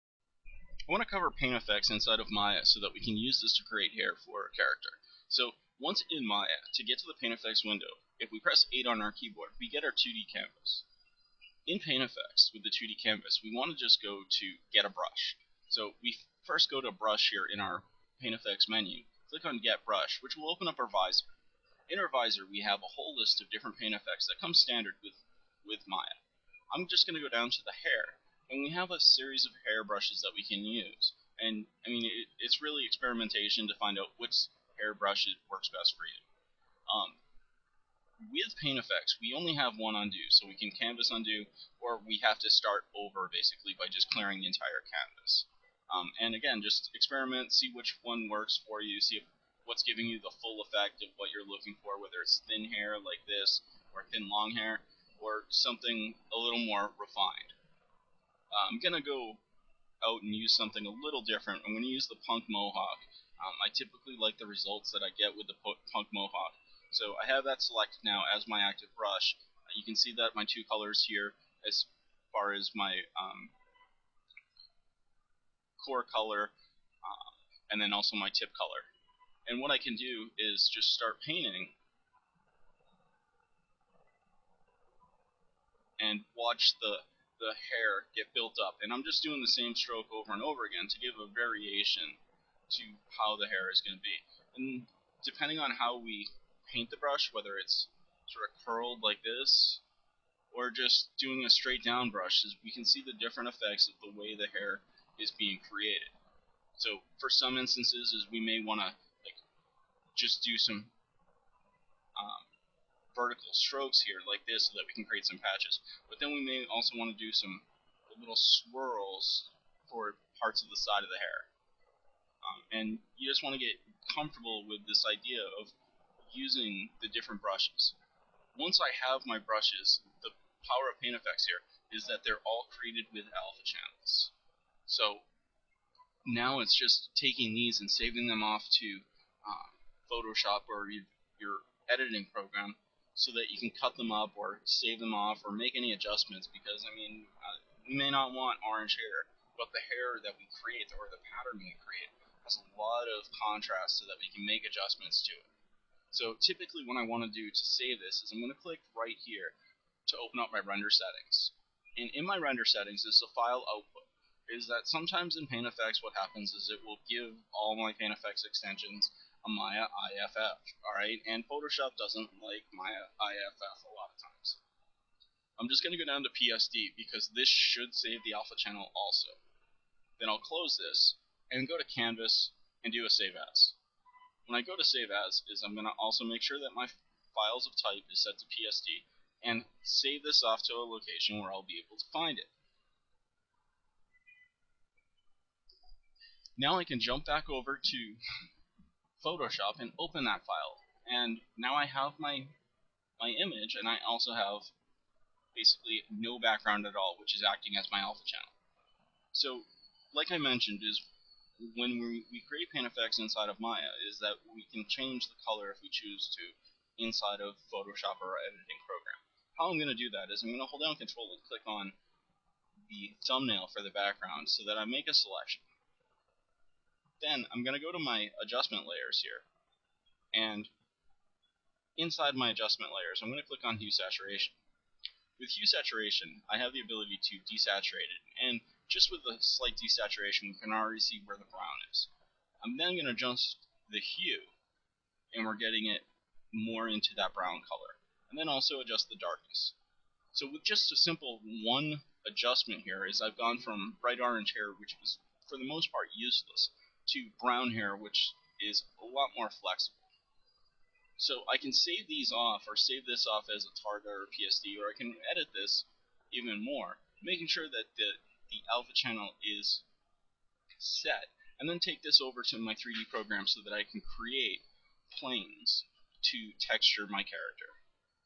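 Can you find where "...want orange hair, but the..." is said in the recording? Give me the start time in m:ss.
2:28.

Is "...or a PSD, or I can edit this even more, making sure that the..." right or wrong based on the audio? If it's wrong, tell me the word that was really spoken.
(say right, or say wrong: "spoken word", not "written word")
right.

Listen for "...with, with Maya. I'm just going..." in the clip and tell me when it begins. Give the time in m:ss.
0:25.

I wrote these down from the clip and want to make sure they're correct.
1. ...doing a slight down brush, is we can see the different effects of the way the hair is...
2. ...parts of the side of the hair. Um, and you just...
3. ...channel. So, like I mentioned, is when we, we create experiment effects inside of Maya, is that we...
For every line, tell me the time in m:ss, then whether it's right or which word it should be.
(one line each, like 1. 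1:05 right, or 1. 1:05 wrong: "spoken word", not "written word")
1. 1:41 wrong: "straight", not "slight"
2. 2:00 right
3. 3:28 wrong: "paint", not "experiment".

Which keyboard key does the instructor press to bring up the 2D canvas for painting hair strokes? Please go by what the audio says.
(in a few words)
8.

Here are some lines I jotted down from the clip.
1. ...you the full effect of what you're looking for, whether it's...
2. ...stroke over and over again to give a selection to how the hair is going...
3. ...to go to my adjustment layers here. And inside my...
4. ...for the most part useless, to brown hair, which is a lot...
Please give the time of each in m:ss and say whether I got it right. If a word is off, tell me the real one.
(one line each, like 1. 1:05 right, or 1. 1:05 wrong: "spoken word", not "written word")
1. 0:50 right
2. 1:29 wrong: "variation", not "selection"
3. 3:47 right
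4. 4:15 right.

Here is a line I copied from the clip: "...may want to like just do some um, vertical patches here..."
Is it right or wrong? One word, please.
wrong.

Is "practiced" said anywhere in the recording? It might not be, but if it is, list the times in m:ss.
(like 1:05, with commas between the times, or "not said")
not said.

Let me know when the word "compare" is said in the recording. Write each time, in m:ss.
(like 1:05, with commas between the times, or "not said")
not said.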